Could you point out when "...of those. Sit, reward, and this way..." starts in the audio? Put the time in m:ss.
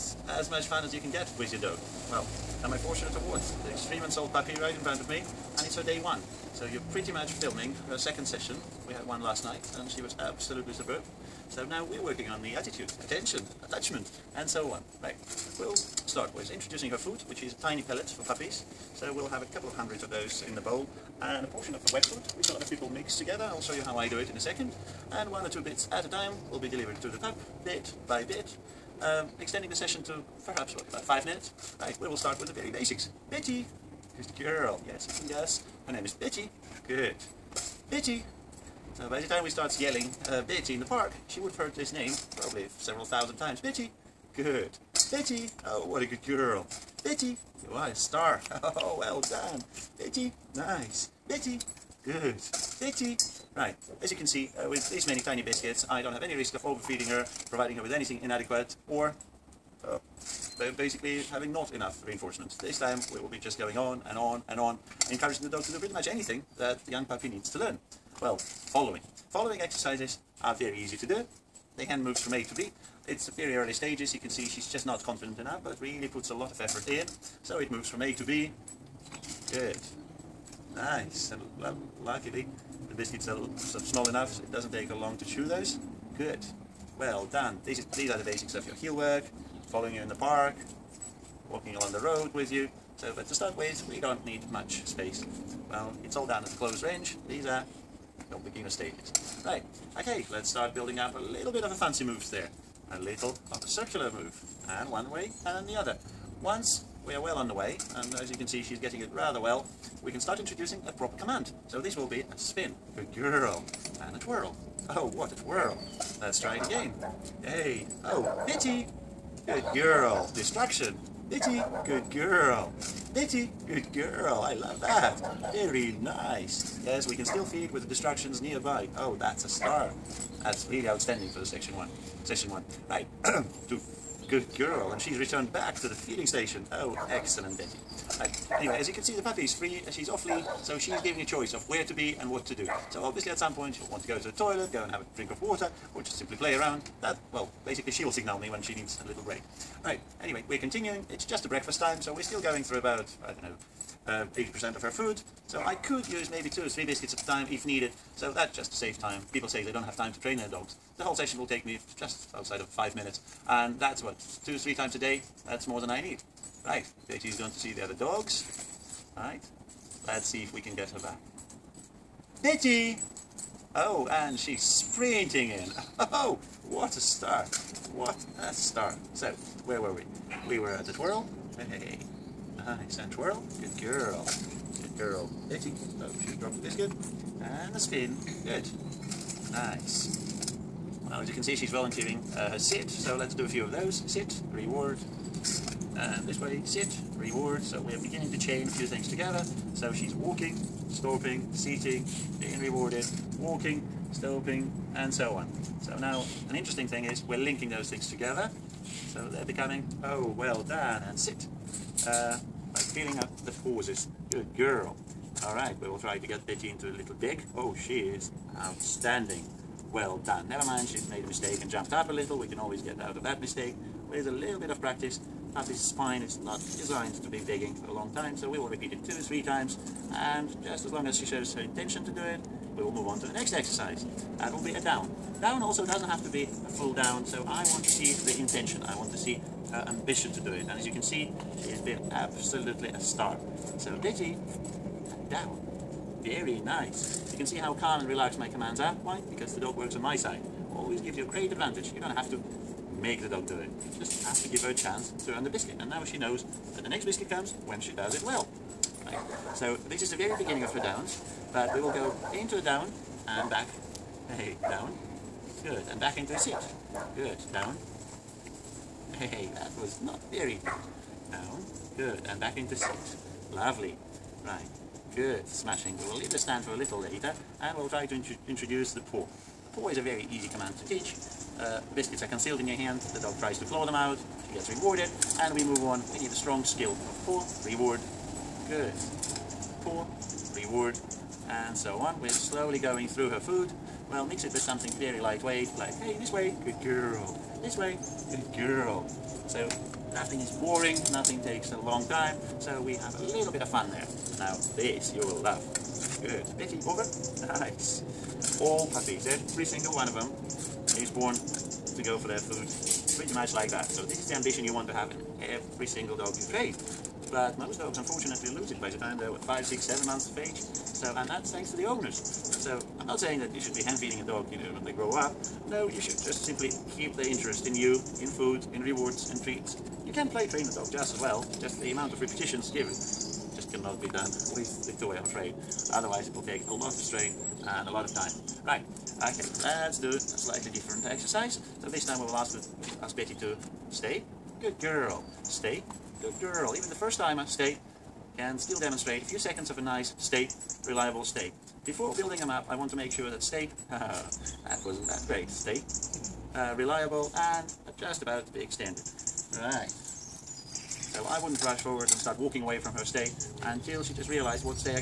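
3:13.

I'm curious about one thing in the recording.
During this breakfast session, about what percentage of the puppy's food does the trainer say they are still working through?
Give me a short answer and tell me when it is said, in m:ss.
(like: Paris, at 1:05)
80%, at 2:34.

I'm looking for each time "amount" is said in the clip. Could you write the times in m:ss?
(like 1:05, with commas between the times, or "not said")
5:31.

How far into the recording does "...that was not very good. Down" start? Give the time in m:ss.
4:29.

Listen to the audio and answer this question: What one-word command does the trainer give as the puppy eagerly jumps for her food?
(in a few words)
Over.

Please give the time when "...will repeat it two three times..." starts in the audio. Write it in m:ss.
3:48.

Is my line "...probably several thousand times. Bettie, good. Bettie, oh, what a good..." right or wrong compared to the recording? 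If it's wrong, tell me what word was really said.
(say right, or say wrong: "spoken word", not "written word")
right.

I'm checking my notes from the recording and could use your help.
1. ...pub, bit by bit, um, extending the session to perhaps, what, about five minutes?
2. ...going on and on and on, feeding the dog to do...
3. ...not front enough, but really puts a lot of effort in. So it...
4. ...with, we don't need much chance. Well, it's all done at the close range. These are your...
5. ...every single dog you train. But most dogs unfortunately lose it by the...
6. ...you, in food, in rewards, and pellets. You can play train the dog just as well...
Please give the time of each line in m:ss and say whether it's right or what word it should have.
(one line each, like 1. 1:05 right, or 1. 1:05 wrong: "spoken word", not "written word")
1. 0:27 right
2. 1:03 wrong: "encouraging", not "feeding"
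3. 1:14 wrong: "confident", not "front"
4. 1:33 wrong: "space", not "chance"
5. 5:15 right
6. 5:27 wrong: "treats", not "pellets".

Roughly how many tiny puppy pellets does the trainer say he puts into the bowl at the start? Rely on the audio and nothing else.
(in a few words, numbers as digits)
A couple of hundred.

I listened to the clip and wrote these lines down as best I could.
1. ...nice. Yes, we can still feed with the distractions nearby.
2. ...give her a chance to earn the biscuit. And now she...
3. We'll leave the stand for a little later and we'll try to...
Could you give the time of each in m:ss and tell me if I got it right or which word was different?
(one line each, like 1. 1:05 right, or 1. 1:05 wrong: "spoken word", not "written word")
1. 2:06 right
2. 4:14 right
3. 4:36 right.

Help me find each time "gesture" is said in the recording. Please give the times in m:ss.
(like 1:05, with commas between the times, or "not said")
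not said.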